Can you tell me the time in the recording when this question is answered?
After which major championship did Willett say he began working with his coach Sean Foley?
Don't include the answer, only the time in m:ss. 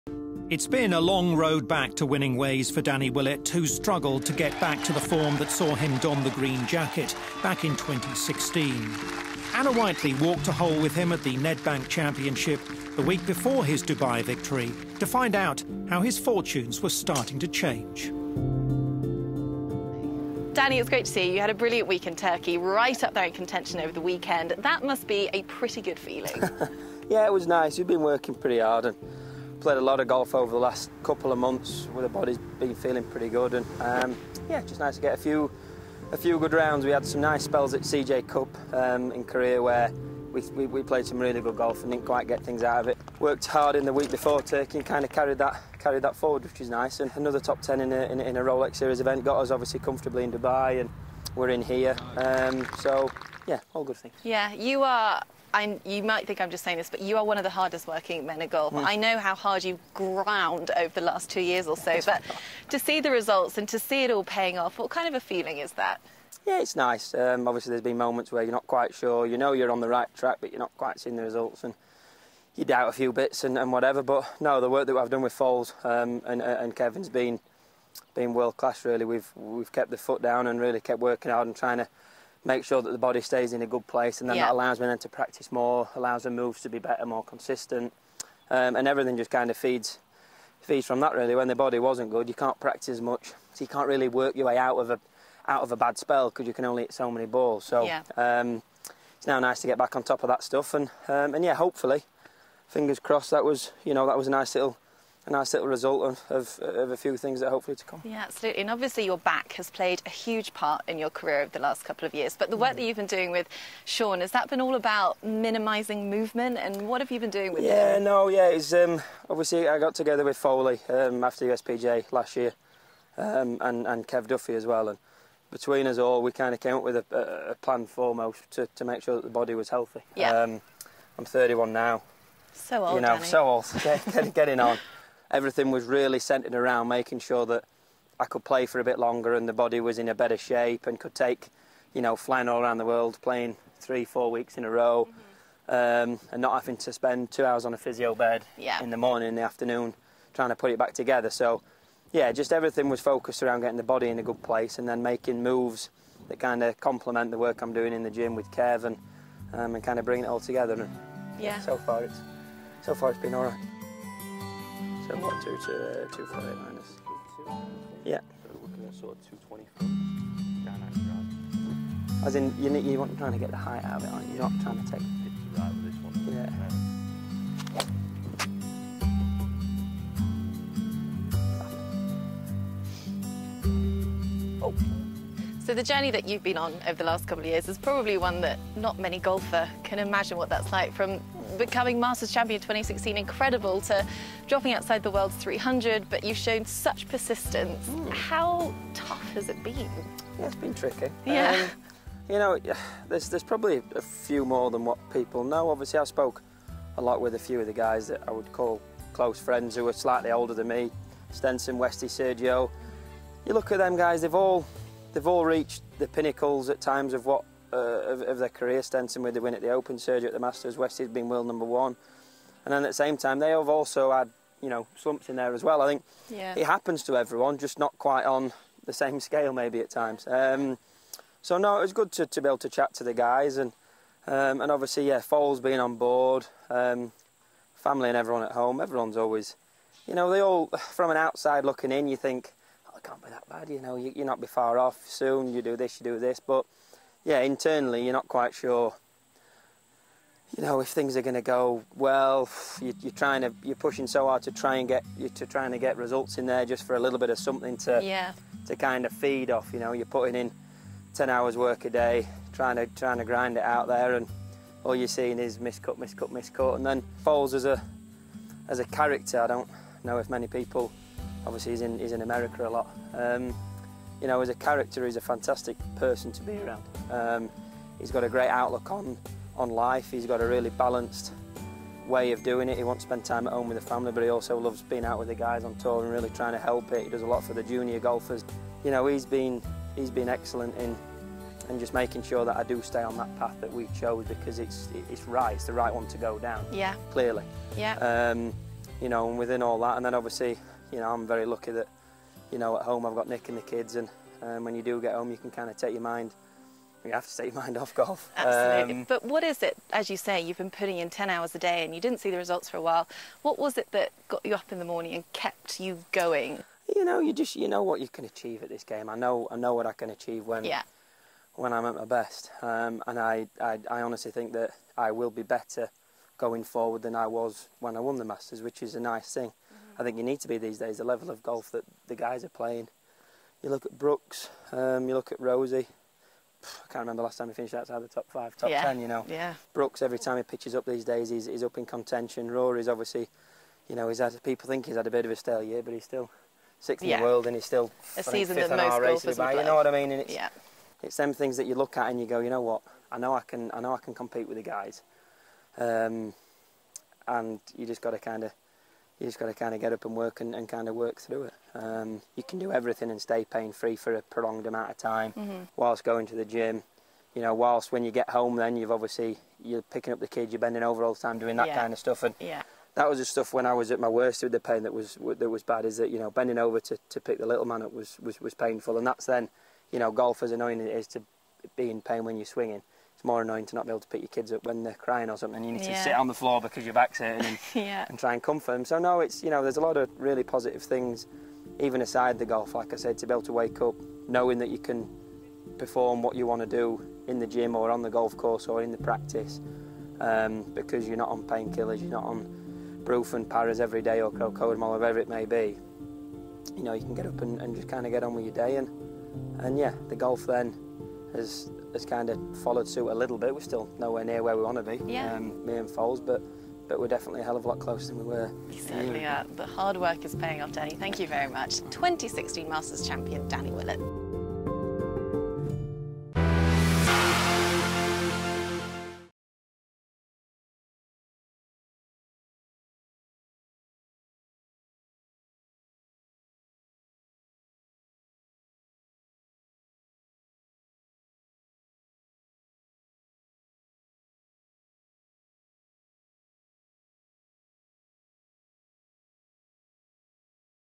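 2:01.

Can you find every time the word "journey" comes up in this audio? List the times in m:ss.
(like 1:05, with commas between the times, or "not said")
3:05.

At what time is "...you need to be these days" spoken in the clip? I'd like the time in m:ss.
5:30.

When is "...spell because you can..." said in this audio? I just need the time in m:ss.
1:35.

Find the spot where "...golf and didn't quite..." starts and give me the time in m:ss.
0:41.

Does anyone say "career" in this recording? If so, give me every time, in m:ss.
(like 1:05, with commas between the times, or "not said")
1:51, 3:38.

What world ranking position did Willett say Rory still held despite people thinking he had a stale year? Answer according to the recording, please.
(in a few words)
6th.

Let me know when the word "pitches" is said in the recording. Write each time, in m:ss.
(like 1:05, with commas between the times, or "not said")
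5:40.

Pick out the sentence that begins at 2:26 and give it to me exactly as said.
um, and not having to spend two hours on a physio bed yeah.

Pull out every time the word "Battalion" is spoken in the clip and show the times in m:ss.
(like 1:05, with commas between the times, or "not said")
not said.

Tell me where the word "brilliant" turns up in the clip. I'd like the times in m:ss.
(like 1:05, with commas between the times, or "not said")
0:21.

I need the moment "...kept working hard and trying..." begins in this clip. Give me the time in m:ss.
1:20.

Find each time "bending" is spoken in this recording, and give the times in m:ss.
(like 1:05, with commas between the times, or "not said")
6:10, 6:16.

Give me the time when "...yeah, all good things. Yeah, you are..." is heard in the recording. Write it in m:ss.
0:53.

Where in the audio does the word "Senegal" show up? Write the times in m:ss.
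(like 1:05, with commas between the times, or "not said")
not said.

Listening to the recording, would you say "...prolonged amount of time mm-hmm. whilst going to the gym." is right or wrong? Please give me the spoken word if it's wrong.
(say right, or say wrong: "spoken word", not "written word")
right.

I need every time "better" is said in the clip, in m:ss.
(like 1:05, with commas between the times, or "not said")
1:26, 2:20, 5:25.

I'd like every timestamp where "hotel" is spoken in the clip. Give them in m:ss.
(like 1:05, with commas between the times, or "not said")
not said.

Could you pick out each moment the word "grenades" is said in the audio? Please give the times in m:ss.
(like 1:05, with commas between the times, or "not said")
not said.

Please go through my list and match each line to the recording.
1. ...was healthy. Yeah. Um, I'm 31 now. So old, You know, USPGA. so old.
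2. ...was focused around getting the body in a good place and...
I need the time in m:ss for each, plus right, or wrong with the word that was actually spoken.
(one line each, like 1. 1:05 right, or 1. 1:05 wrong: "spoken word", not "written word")
1. 2:09 wrong: "Danny", not "USPGA"
2. 2:32 right.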